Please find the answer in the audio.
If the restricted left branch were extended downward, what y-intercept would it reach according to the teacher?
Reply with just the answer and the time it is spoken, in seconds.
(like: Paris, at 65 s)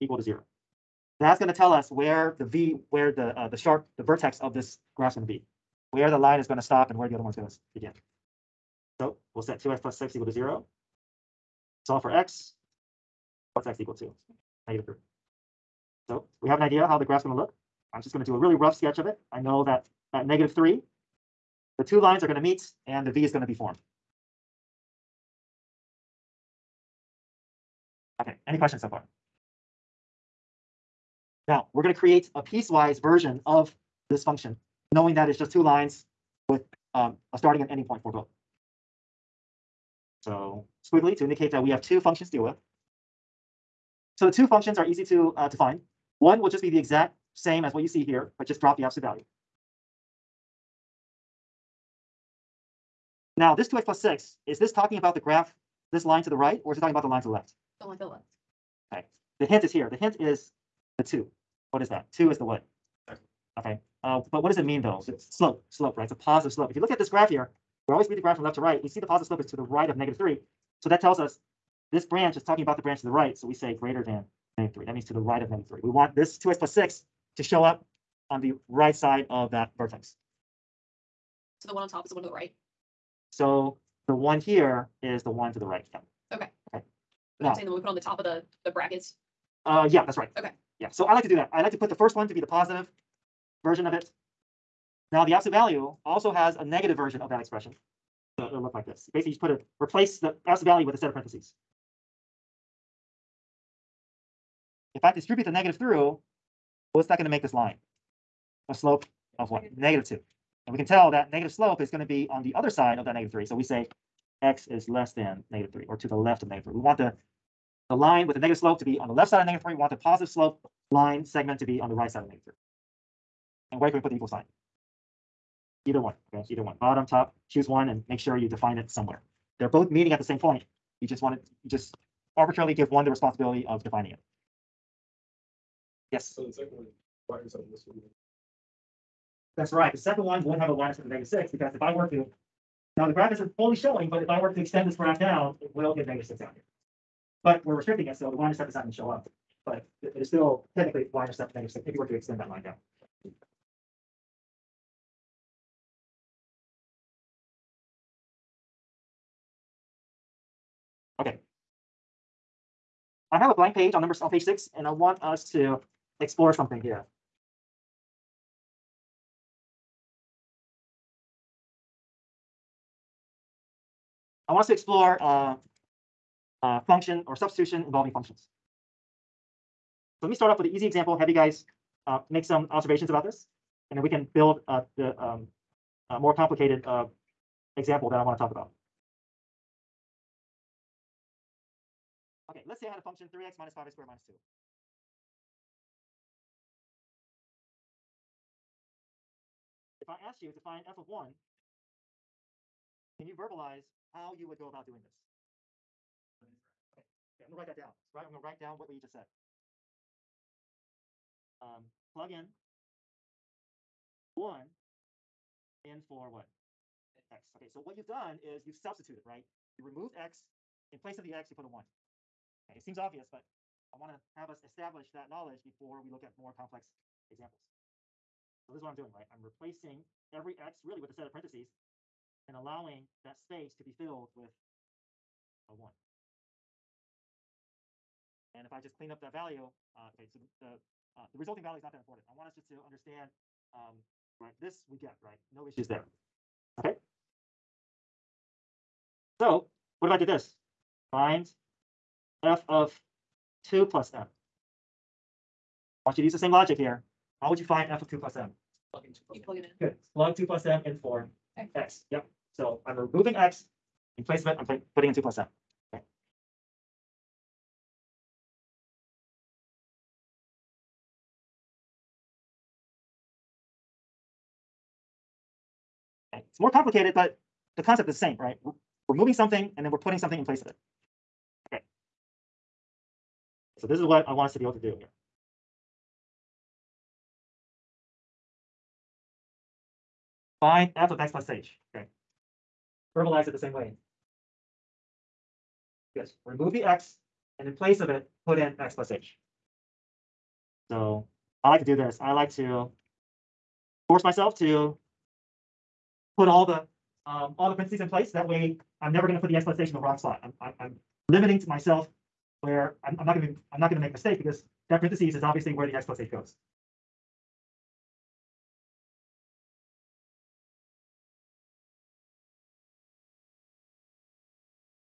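-6, at 151 s.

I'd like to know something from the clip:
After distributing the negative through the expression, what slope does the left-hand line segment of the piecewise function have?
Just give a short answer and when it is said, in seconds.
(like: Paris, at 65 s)
-2, at 109 s.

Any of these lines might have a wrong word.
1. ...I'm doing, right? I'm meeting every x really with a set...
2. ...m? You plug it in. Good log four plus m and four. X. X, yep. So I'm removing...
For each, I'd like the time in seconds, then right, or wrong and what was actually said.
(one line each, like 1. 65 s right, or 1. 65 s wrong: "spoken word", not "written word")
1. 228 s wrong: "replacing", not "meeting"
2. 258 s wrong: "two", not "four".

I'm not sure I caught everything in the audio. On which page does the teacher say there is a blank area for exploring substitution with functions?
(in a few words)
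6.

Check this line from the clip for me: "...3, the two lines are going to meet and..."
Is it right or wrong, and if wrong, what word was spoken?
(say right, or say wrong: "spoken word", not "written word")
right.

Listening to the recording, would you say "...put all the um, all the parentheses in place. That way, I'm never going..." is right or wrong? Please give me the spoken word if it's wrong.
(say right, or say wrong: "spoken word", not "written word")
right.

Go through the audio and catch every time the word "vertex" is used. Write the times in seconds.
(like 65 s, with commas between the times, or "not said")
4 s, 79 s.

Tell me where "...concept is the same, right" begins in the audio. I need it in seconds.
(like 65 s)
277 s.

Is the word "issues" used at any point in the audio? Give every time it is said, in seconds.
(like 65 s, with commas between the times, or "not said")
245 s.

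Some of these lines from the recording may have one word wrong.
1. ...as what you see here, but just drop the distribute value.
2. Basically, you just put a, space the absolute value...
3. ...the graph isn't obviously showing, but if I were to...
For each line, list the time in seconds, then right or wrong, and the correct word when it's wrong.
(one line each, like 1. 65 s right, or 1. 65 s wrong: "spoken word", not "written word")
1. 47 s wrong: "absolute", not "distribute"
2. 99 s wrong: "replace", not "space"
3. 143 s wrong: "fully", not "obviously".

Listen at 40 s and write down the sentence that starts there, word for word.
So squiggly to indicate that we have two functions to deal with.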